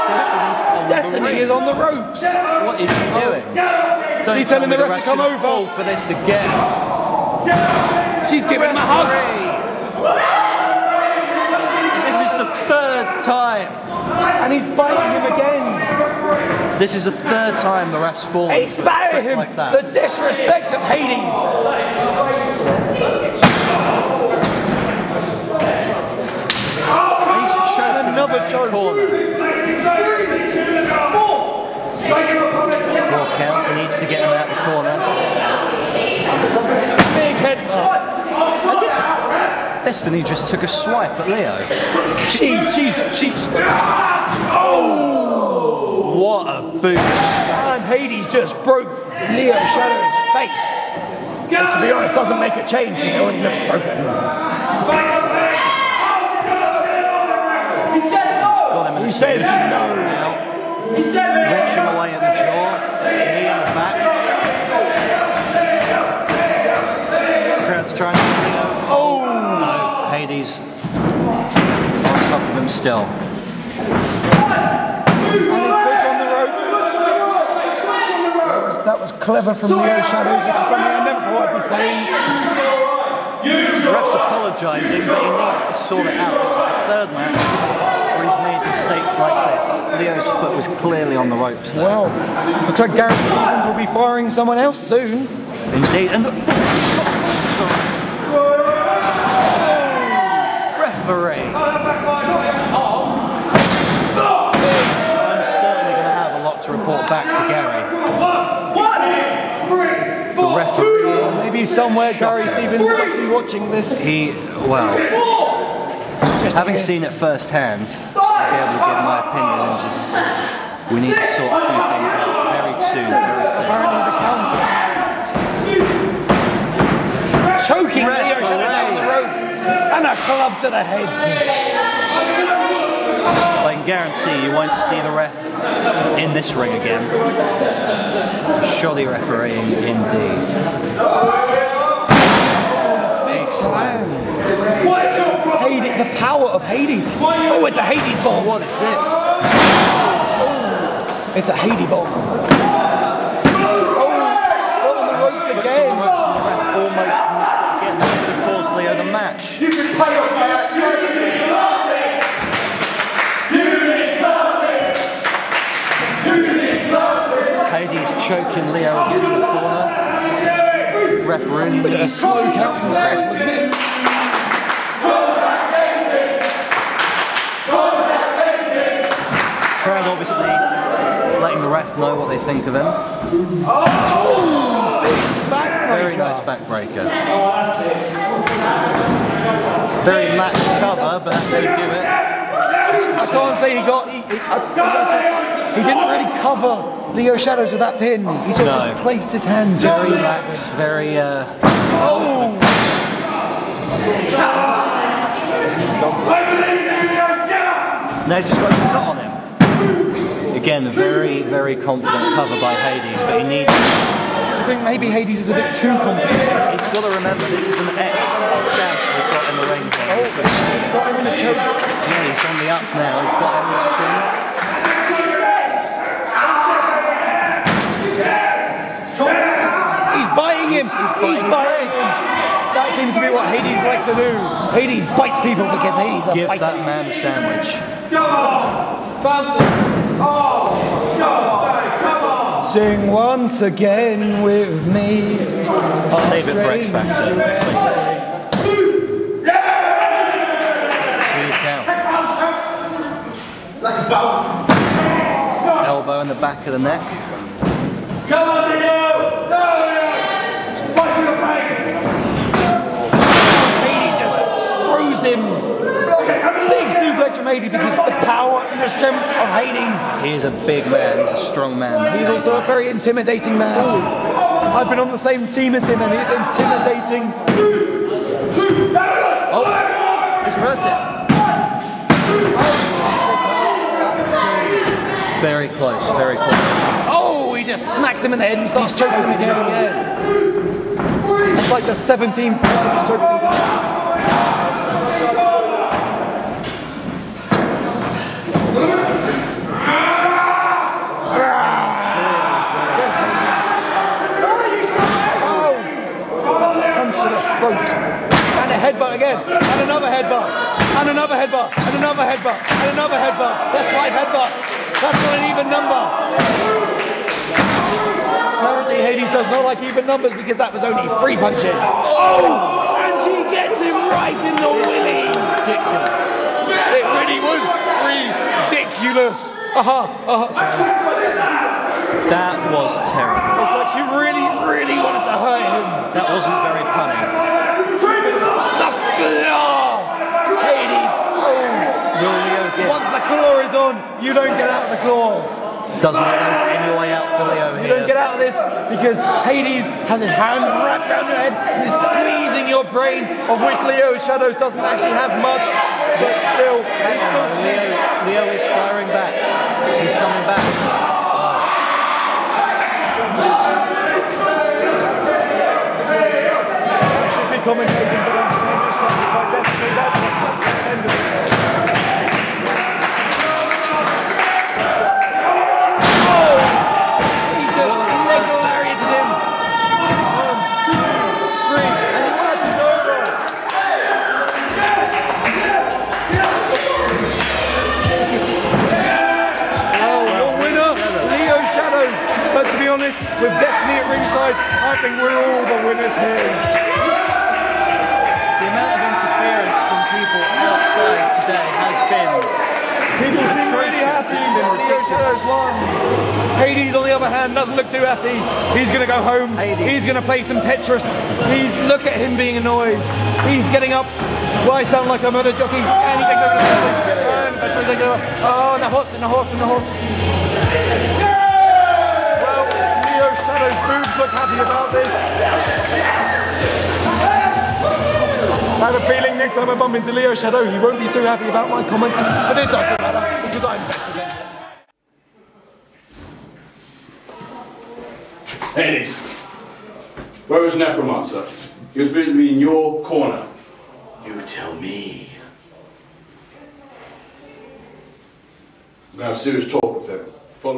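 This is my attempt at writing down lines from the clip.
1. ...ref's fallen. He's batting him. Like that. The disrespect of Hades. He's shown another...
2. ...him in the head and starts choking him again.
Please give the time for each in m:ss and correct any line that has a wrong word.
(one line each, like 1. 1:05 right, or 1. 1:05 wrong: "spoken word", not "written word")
1. 0:17 right
2. 4:48 right.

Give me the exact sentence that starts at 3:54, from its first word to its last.
Hades bites people because Hades Give a that man a sandwich.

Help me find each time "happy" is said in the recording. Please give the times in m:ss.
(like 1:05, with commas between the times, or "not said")
6:44, 6:48, 7:04, 7:11.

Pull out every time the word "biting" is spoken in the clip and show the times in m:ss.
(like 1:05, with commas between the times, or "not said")
0:14, 3:50.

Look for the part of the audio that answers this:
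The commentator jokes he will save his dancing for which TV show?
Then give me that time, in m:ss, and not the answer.
4:06.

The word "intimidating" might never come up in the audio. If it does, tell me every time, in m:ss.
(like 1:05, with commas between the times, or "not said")
4:32, 4:37.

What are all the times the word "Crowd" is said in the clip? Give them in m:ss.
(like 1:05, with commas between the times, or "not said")
1:07, 2:59.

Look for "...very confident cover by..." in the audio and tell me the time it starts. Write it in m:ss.
3:31.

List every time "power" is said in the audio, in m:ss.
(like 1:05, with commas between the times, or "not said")
2:26, 4:28.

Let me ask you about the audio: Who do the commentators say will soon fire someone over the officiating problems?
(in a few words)
Gareth Stevens.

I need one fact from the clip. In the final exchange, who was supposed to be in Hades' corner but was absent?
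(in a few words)
Necromancer.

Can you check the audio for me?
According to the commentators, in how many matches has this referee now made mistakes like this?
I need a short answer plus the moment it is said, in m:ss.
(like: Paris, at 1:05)
3, at 1:26.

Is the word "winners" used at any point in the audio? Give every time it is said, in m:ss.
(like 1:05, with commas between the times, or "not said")
6:35.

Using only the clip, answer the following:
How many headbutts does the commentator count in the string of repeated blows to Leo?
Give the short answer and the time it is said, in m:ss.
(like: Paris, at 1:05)
5, at 5:13.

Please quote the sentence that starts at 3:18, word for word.
He sort of just placed his hand.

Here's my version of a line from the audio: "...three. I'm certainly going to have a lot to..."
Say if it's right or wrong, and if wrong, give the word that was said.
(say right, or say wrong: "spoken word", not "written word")
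right.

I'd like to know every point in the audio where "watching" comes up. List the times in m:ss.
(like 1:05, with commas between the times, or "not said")
1:53.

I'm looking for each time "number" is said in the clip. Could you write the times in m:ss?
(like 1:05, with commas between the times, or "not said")
5:15, 5:20.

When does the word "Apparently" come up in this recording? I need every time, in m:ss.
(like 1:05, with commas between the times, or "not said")
2:06, 5:18.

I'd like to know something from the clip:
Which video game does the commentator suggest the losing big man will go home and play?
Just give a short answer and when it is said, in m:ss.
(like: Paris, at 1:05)
Tetris, at 6:50.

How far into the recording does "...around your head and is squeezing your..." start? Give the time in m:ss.
5:51.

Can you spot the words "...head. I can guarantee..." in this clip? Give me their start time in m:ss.
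2:10.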